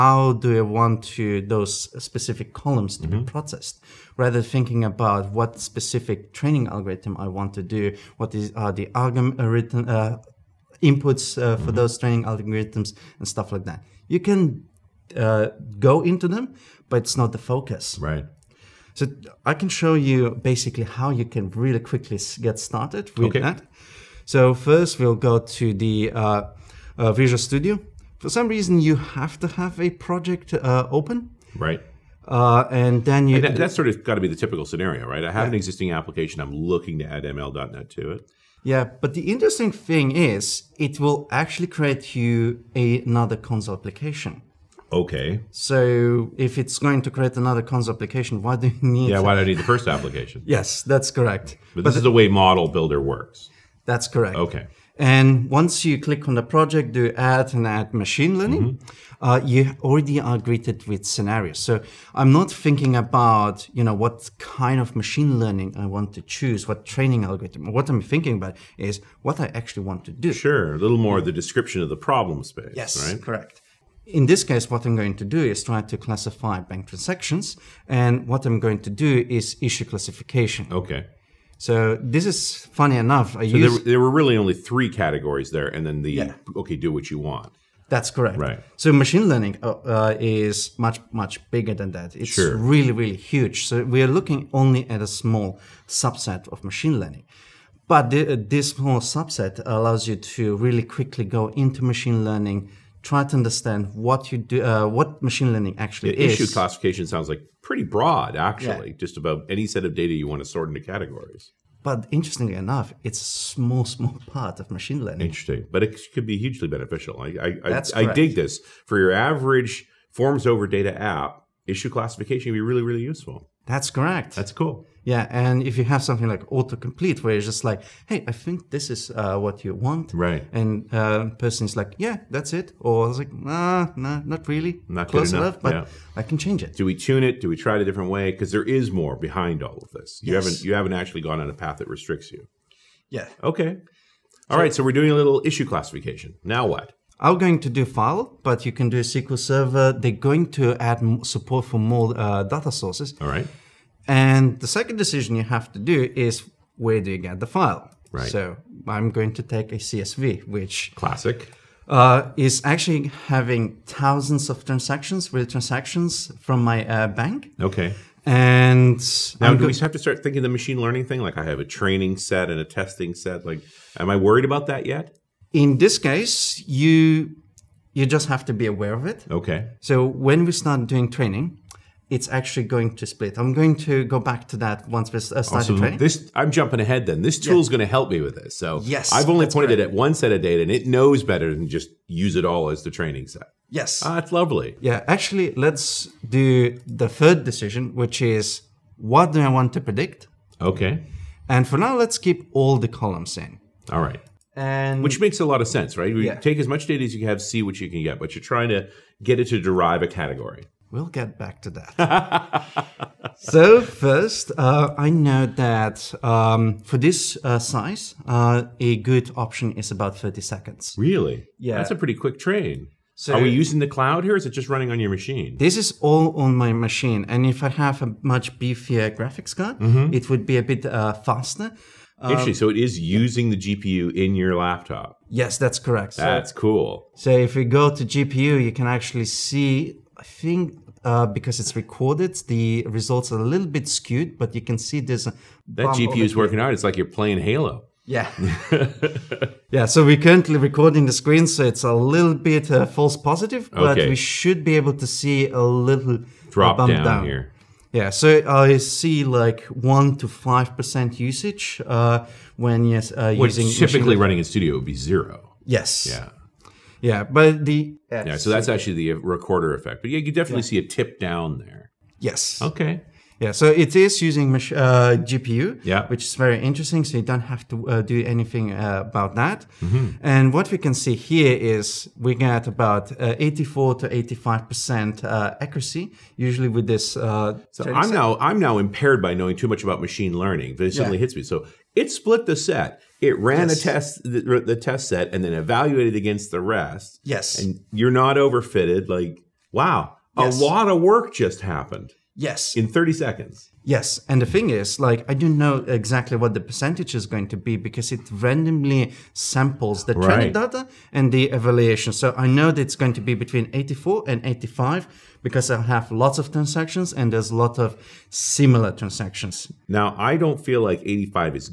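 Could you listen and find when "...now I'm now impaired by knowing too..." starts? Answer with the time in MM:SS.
04:48.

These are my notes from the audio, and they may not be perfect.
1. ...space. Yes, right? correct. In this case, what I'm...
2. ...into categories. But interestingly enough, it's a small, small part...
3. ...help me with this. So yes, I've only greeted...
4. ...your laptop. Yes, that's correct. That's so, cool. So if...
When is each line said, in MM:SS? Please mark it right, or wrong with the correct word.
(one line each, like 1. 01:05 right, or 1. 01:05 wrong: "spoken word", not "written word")
1. 01:12 right
2. 01:50 right
3. 03:07 wrong: "pointed", not "greeted"
4. 03:54 right.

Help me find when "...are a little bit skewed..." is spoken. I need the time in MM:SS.
04:03.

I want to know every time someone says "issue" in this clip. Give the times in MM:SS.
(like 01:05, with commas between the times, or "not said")
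01:19, 01:46, 02:01, 02:25.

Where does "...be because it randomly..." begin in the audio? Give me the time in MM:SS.
05:07.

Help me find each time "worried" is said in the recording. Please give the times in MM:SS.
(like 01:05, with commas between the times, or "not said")
02:54.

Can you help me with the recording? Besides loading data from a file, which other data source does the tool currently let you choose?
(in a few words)
SQL Server.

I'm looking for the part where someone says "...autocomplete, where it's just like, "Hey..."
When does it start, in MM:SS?
02:06.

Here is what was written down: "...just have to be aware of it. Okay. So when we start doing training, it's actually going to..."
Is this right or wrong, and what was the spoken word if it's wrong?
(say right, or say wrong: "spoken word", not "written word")
right.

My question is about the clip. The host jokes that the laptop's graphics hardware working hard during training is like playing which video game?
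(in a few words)
Halo.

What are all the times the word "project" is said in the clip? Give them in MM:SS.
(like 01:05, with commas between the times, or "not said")
00:29, 00:56.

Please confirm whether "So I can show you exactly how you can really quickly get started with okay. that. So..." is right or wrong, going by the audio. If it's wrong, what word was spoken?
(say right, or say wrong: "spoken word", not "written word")
wrong: "basically", not "exactly".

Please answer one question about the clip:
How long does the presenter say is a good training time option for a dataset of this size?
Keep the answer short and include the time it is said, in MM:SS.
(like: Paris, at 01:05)
30 seconds, at 03:39.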